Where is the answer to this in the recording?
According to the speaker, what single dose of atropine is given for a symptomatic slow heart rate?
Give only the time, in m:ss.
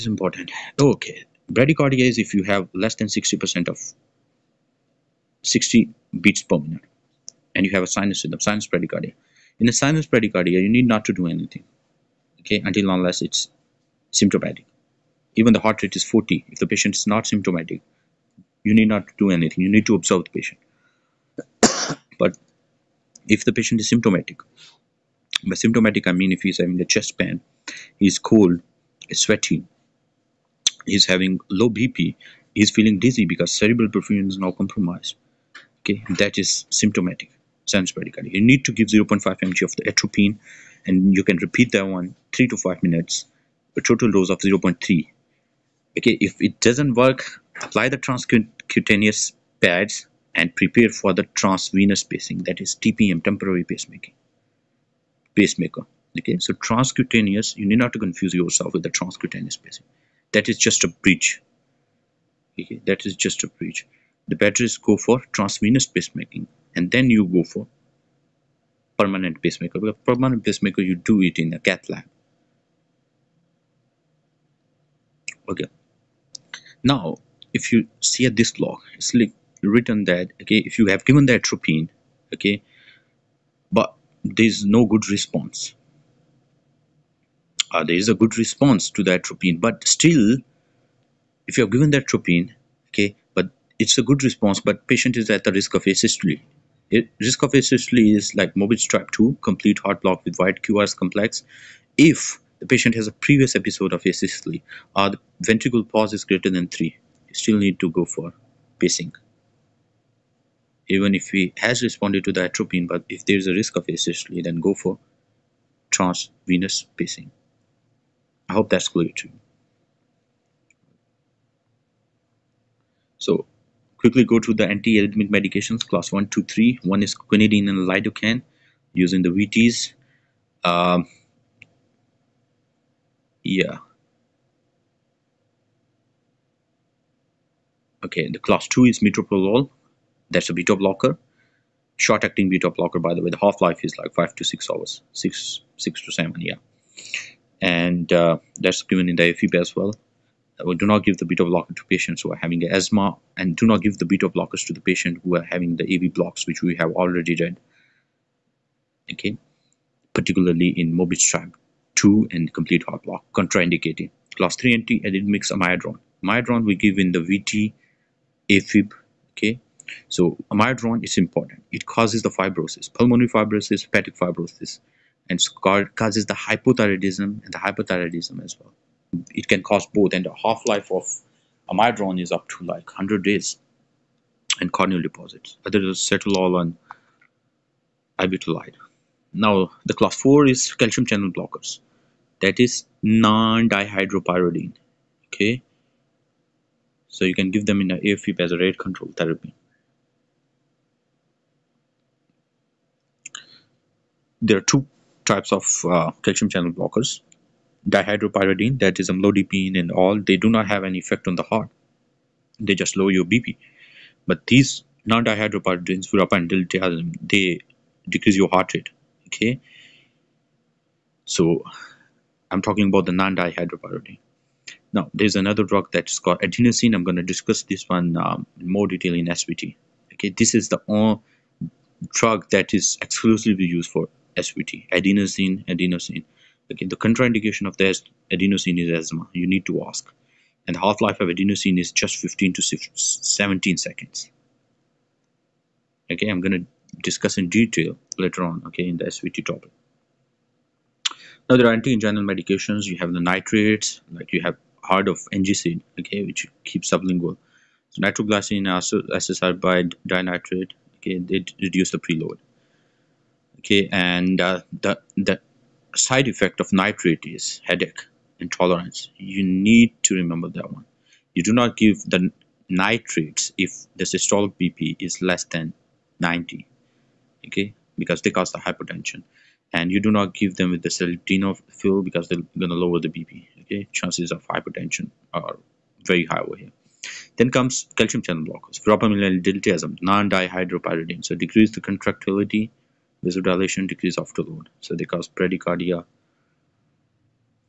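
0:38.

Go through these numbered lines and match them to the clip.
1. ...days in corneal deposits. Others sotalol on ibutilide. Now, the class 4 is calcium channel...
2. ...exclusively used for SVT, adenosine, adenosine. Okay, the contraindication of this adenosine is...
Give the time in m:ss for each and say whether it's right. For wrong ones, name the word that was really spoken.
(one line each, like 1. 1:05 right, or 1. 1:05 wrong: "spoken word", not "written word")
1. 3:03 right
2. 3:53 right.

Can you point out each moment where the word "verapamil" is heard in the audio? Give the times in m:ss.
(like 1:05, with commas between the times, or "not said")
3:36.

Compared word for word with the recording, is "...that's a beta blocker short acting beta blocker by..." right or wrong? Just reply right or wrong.
right.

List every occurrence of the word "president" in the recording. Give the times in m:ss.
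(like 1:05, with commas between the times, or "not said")
not said.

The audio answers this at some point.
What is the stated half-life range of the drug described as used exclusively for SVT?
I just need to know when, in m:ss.
4:02.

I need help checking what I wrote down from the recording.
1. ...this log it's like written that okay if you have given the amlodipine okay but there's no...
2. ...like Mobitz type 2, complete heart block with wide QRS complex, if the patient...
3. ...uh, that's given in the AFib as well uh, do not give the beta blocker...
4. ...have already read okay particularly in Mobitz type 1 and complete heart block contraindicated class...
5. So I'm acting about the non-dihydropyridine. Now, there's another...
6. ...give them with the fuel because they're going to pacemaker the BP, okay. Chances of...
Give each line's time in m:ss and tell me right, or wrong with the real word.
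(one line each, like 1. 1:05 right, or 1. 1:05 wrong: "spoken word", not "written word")
1. 1:18 wrong: "atropine", not "amlodipine"
2. 1:38 right
3. 2:28 right
4. 2:36 wrong: "2", not "1"
5. 3:41 wrong: "talking", not "acting"
6. 4:40 wrong: "lower", not "pacemaker".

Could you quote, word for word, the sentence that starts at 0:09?
In a sinus bradycardia, you need not to do anything, okay, until unless it's symptomatic.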